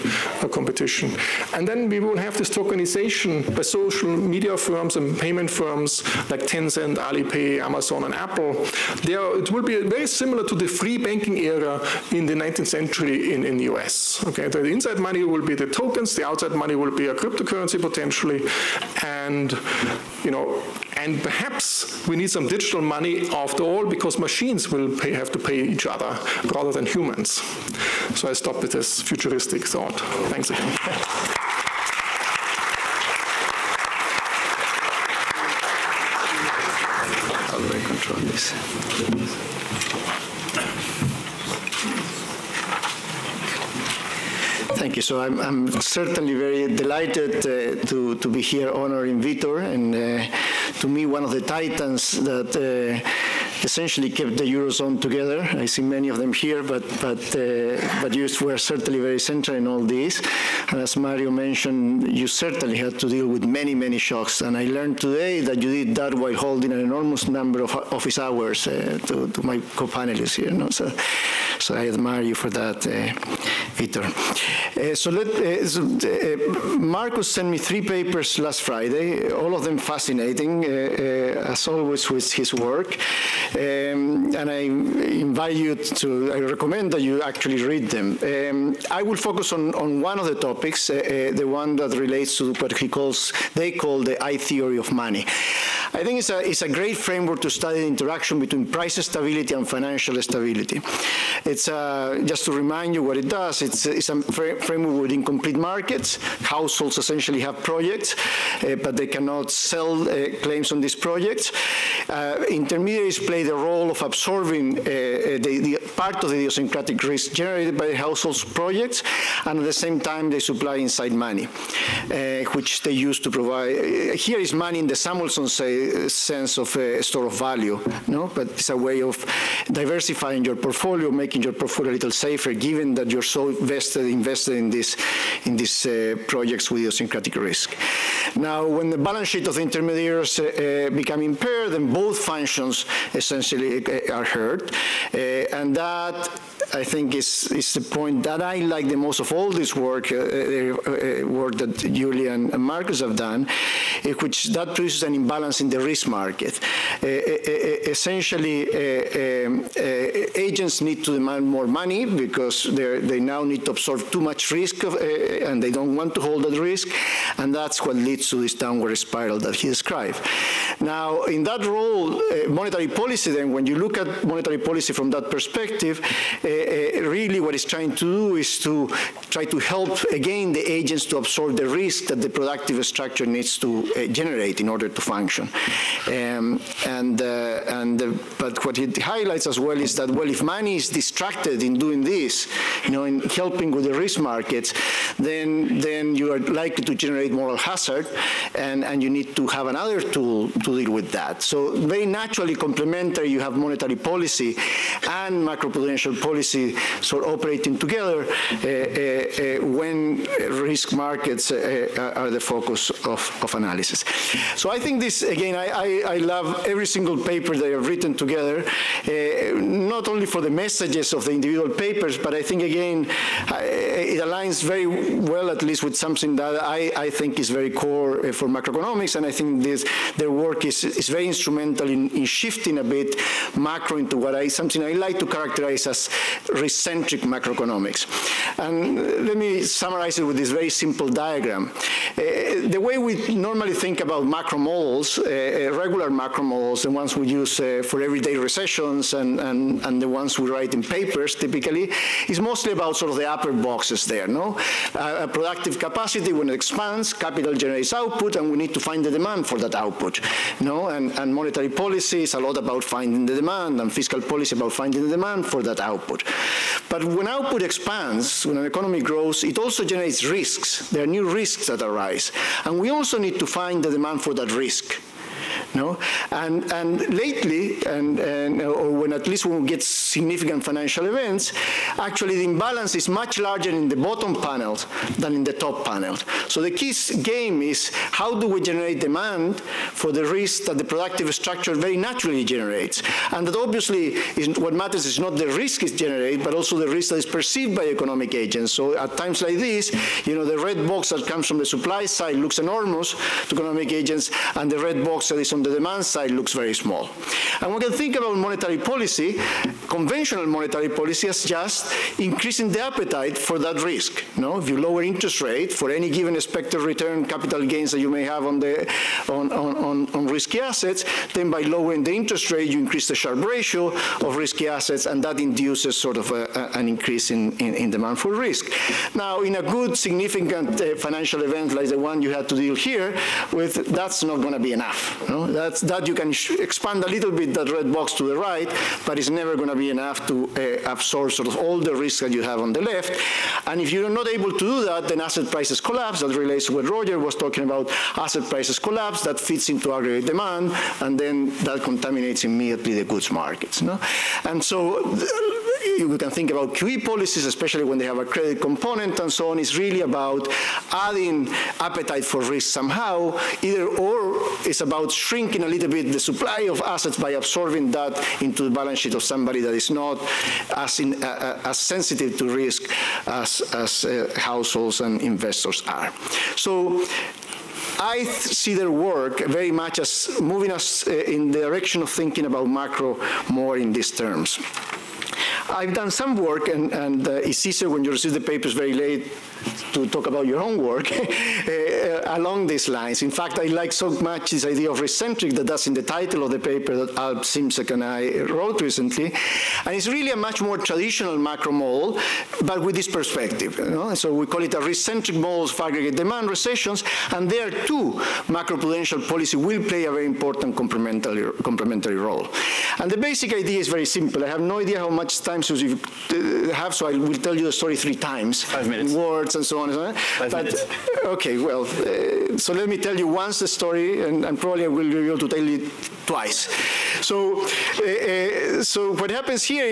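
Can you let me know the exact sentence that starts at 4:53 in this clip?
And that obviously is, what matters is not the risk it generates, but also the risk that is perceived by economic agents.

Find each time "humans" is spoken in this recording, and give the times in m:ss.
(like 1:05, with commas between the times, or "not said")
0:26.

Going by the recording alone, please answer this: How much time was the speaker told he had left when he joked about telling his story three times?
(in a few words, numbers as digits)
5 minutes.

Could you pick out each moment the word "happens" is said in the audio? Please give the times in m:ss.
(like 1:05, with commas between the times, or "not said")
7:09.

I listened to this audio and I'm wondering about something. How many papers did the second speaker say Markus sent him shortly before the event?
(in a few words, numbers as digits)
3.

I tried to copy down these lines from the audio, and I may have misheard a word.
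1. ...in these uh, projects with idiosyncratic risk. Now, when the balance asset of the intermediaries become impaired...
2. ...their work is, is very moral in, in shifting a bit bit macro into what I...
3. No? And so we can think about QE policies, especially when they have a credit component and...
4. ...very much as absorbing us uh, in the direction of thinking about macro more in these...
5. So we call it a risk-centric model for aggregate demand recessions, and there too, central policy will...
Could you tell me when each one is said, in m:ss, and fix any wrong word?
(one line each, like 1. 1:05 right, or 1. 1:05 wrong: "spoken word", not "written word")
1. 2:15 wrong: "sheet", not "asset"
2. 3:50 wrong: "instrumental", not "moral"
3. 5:53 right
4. 6:19 wrong: "moving", not "absorbing"
5. 6:44 wrong: "macroprudential", not "central".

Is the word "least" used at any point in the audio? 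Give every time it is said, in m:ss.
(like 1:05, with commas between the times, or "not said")
3:45, 4:39.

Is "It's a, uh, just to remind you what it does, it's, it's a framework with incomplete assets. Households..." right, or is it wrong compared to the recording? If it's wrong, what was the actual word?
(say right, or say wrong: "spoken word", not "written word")
wrong: "markets", not "assets".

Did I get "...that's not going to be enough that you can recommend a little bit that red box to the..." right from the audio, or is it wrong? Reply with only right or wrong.
wrong.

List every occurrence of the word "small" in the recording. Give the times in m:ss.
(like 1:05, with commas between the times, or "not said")
5:06.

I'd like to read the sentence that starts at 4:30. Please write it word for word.
There are new risks that arise.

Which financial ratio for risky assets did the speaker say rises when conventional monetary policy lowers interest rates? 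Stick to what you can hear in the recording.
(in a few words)
Sharpe ratio.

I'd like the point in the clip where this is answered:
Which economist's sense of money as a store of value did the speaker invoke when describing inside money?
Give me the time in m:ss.
2:05.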